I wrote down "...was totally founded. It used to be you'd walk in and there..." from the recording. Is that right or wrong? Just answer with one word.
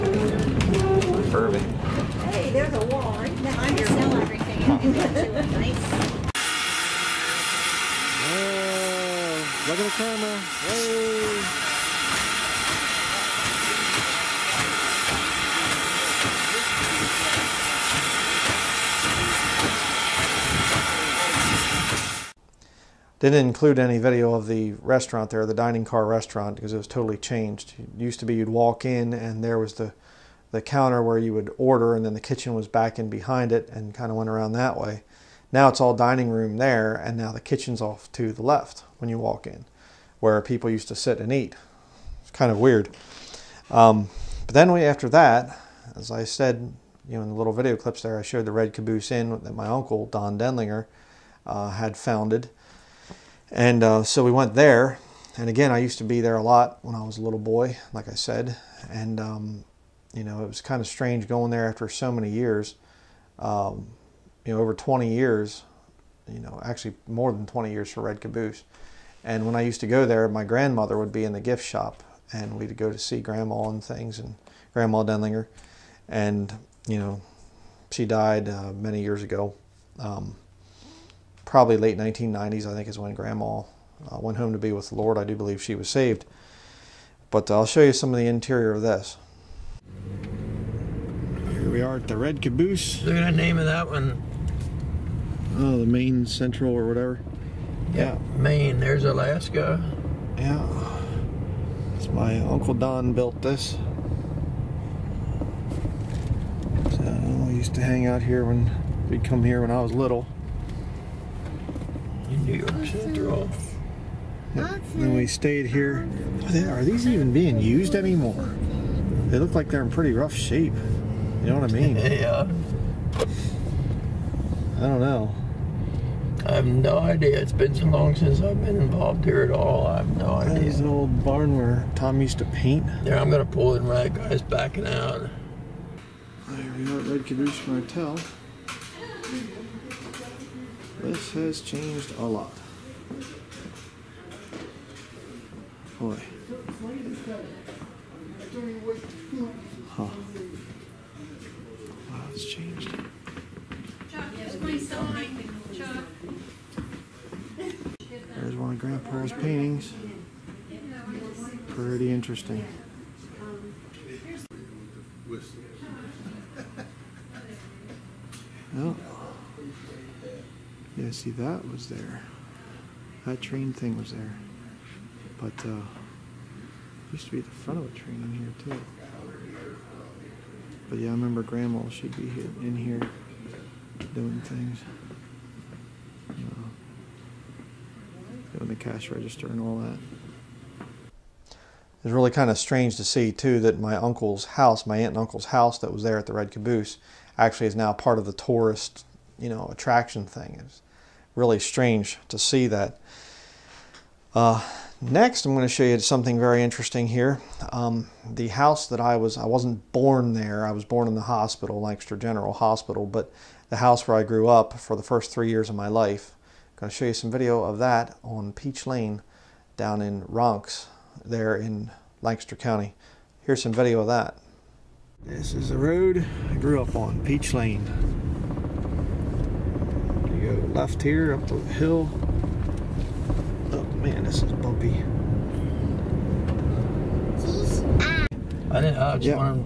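wrong.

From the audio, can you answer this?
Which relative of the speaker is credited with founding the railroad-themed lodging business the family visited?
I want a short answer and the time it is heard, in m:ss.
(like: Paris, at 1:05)
Don Denlinger, at 0:50.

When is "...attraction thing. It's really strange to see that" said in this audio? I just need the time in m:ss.
3:19.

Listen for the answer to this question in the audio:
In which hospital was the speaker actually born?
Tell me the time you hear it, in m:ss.
3:31.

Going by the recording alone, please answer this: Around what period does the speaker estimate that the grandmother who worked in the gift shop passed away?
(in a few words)
late 1990s.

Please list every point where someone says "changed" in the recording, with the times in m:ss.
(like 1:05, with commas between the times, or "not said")
0:27, 2:21, 2:32.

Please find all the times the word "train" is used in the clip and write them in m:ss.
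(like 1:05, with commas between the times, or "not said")
2:53, 2:57.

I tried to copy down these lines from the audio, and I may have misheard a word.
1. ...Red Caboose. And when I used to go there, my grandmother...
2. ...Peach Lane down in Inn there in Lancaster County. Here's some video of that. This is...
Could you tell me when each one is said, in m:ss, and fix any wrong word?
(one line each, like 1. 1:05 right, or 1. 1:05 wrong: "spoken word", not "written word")
1. 1:08 right
2. 3:38 wrong: "Ronks", not "Inn".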